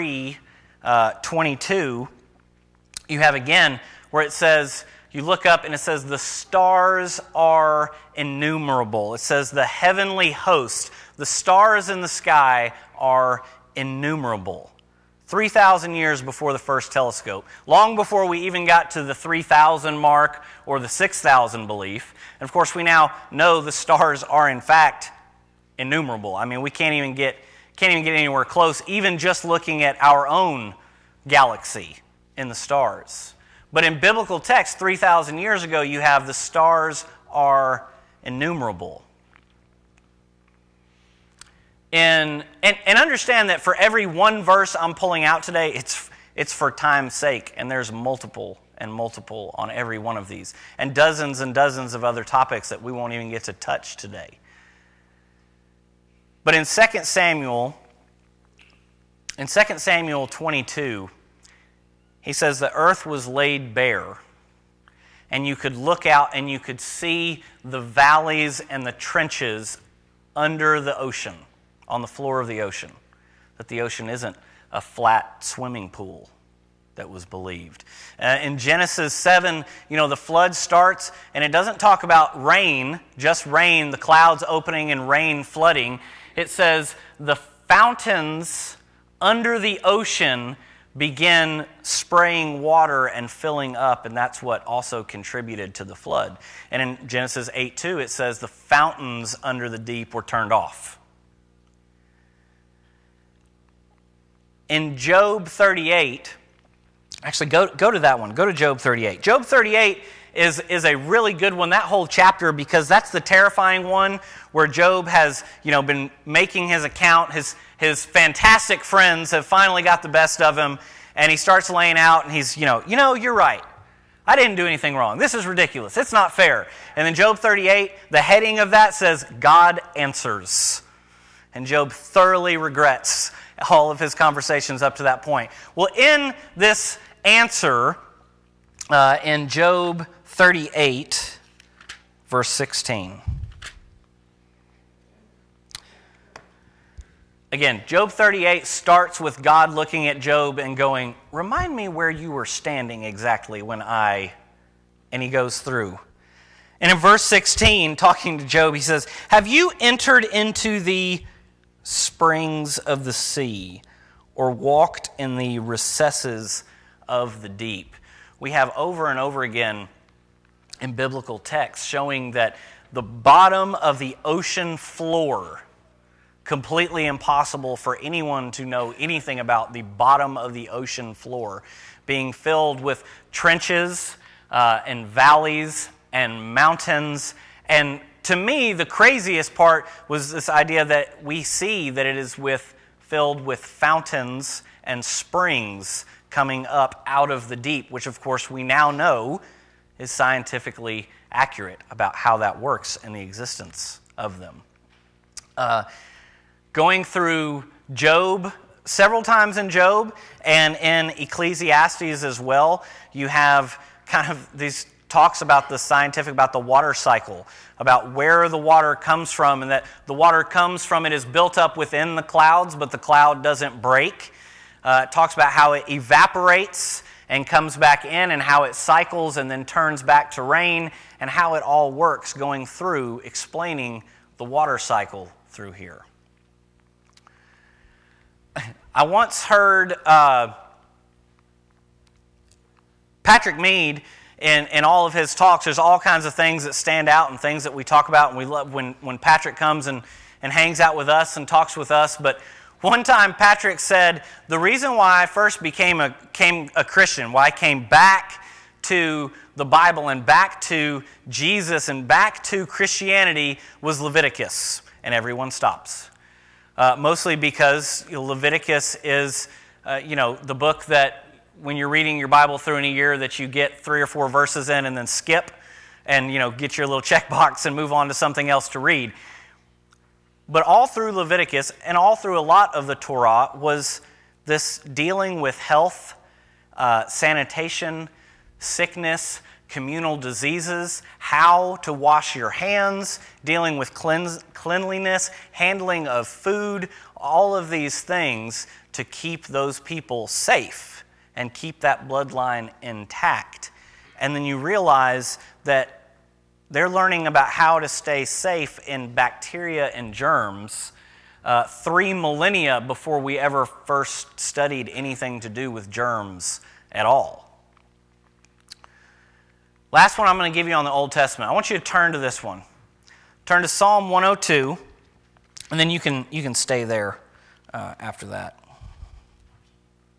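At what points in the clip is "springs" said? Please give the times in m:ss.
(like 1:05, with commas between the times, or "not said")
2:41, 3:15.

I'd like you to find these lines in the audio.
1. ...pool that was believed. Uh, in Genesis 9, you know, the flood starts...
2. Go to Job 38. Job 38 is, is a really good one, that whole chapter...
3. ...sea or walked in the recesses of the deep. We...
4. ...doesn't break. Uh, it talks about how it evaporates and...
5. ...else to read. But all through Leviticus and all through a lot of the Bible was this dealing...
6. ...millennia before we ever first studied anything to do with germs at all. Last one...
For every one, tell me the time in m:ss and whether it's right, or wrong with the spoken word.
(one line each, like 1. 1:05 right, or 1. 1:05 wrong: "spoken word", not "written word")
1. 1:15 wrong: "7", not "9"
2. 1:48 right
3. 2:43 right
4. 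3:43 right
5. 4:38 wrong: "Torah", not "Bible"
6. 5:12 right.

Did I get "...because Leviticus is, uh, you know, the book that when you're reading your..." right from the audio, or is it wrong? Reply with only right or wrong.
right.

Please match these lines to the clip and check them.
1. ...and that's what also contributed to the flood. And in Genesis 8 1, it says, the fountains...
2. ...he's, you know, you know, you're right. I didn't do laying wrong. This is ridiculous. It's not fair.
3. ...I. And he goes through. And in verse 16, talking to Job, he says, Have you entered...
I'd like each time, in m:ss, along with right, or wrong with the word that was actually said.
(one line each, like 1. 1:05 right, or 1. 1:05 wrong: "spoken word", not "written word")
1. 1:34 wrong: "2", not "1"
2. 2:02 wrong: "anything", not "laying"
3. 2:33 right.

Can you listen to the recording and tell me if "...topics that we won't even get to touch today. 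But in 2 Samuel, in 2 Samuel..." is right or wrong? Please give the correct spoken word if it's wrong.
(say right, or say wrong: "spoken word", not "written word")
right.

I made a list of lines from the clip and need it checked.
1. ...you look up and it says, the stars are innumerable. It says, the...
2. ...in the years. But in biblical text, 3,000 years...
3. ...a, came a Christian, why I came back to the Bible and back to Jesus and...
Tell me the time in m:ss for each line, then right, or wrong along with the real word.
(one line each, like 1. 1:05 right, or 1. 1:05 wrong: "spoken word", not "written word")
1. 0:05 right
2. 0:32 wrong: "stars", not "years"
3. 4:16 right.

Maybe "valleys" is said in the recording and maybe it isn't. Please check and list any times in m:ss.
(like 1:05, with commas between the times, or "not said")
1:07, 3:05.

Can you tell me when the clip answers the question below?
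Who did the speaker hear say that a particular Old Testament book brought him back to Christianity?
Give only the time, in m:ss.
4:03.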